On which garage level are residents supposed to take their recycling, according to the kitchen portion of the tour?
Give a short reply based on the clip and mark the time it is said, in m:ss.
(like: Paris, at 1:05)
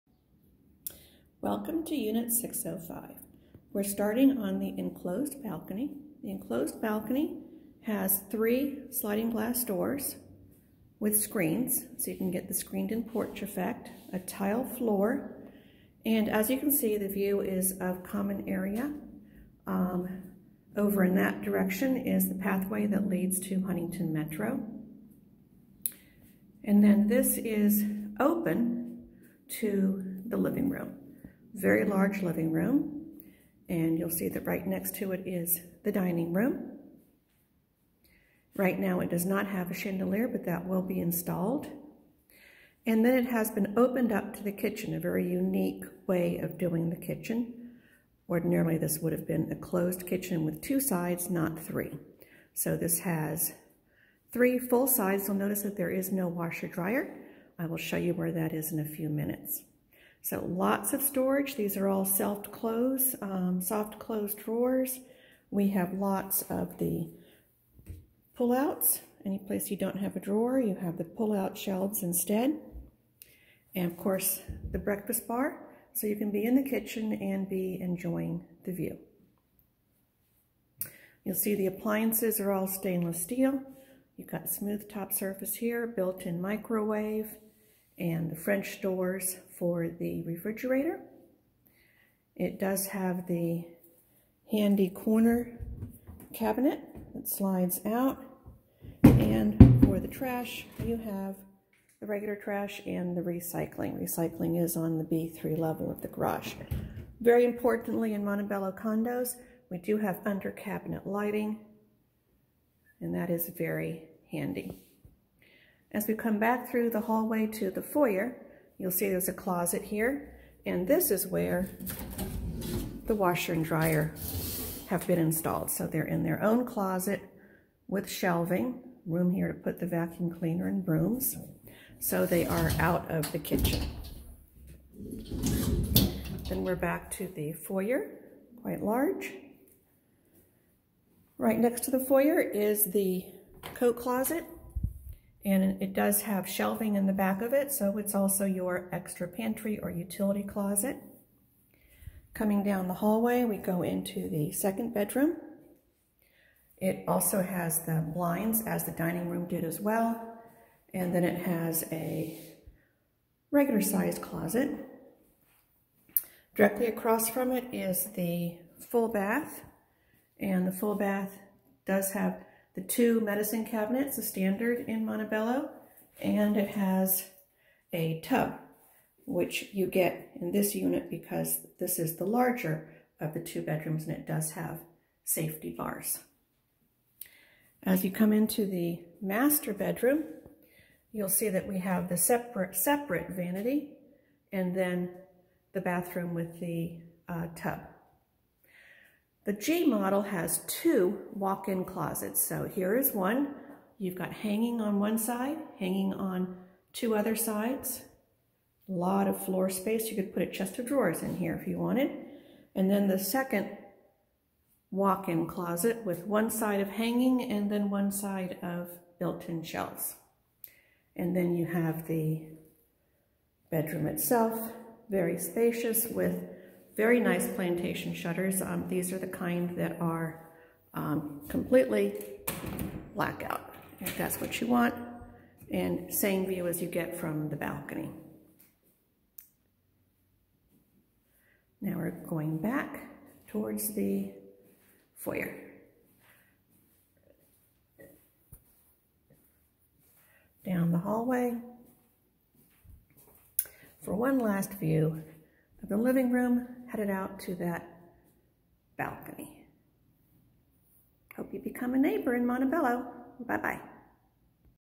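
B3, at 1:45.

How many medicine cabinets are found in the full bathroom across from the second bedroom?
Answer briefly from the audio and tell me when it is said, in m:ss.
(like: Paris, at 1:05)
2, at 2:52.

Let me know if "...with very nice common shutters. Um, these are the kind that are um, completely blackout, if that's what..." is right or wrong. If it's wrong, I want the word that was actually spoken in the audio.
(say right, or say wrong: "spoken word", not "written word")
wrong: "plantation", not "common".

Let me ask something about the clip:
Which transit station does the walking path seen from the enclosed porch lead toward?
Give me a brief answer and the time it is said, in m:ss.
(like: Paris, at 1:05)
Huntington Metro, at 0:23.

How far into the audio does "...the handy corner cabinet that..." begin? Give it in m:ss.
1:33.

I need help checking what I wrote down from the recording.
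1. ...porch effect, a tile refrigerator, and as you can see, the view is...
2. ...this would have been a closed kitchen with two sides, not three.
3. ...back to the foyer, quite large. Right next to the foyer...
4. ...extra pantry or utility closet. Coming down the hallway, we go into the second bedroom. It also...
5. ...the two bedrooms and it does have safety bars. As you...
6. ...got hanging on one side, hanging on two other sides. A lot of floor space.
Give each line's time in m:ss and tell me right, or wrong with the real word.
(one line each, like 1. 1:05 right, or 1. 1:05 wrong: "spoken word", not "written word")
1. 0:13 wrong: "floor", not "refrigerator"
2. 0:48 right
3. 2:16 right
4. 2:28 right
5. 3:03 right
6. 3:24 right.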